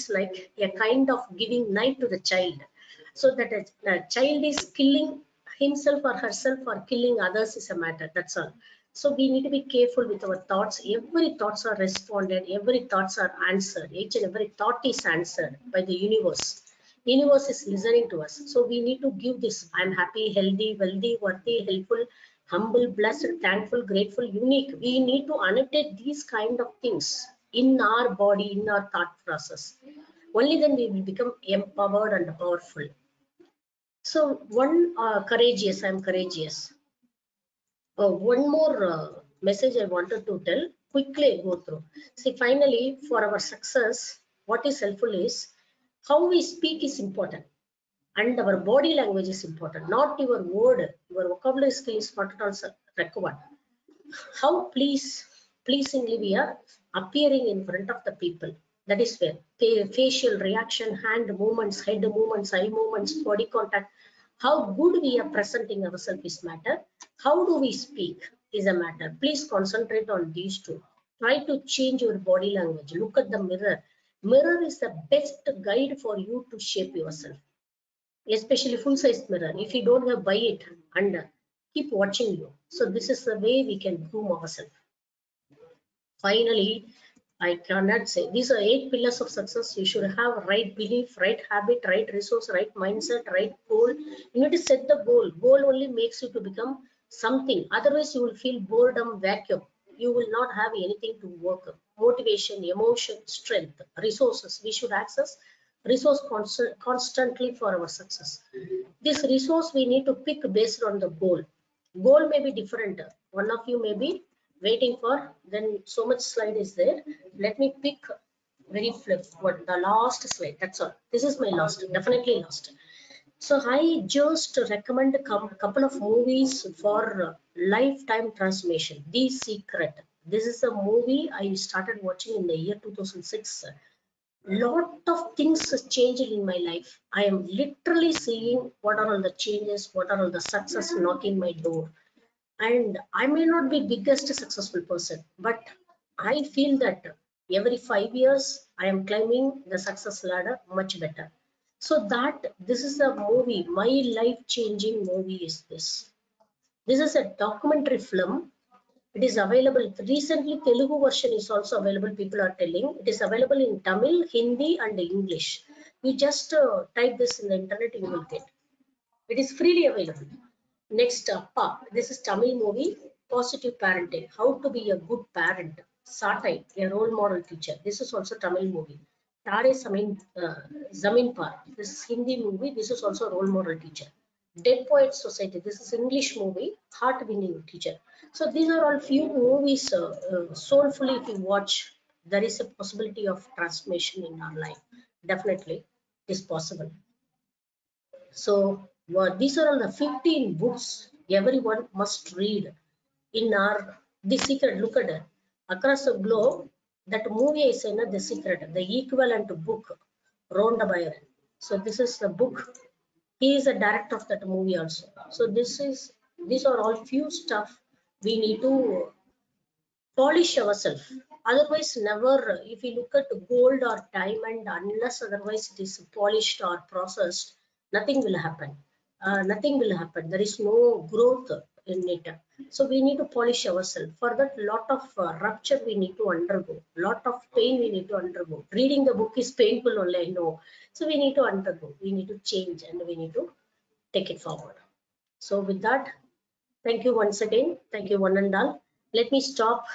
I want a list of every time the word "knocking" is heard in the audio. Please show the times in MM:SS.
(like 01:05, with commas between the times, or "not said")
02:20.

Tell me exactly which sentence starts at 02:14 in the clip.
Lot of things changed in my life.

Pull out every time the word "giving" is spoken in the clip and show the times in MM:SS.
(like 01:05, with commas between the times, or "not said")
00:01.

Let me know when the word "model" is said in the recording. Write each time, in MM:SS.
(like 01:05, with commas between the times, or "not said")
02:57, 03:03.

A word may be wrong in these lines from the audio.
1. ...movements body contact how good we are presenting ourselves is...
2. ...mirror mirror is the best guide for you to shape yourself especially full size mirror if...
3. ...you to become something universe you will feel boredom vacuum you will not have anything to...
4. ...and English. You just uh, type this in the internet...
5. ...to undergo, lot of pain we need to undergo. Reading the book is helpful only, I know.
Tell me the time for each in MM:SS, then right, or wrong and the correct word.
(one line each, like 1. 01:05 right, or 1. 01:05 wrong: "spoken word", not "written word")
1. 01:02 right
2. 01:13 right
3. 01:36 wrong: "otherwise", not "universe"
4. 02:44 right
5. 03:56 wrong: "painful", not "helpful".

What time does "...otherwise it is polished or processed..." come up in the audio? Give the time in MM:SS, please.
03:45.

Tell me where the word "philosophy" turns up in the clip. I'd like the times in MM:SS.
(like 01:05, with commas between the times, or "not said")
not said.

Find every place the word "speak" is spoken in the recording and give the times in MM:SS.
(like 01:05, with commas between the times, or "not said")
00:46, 01:07.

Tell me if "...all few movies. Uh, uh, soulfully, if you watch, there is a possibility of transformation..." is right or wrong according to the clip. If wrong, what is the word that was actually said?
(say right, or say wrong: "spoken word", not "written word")
right.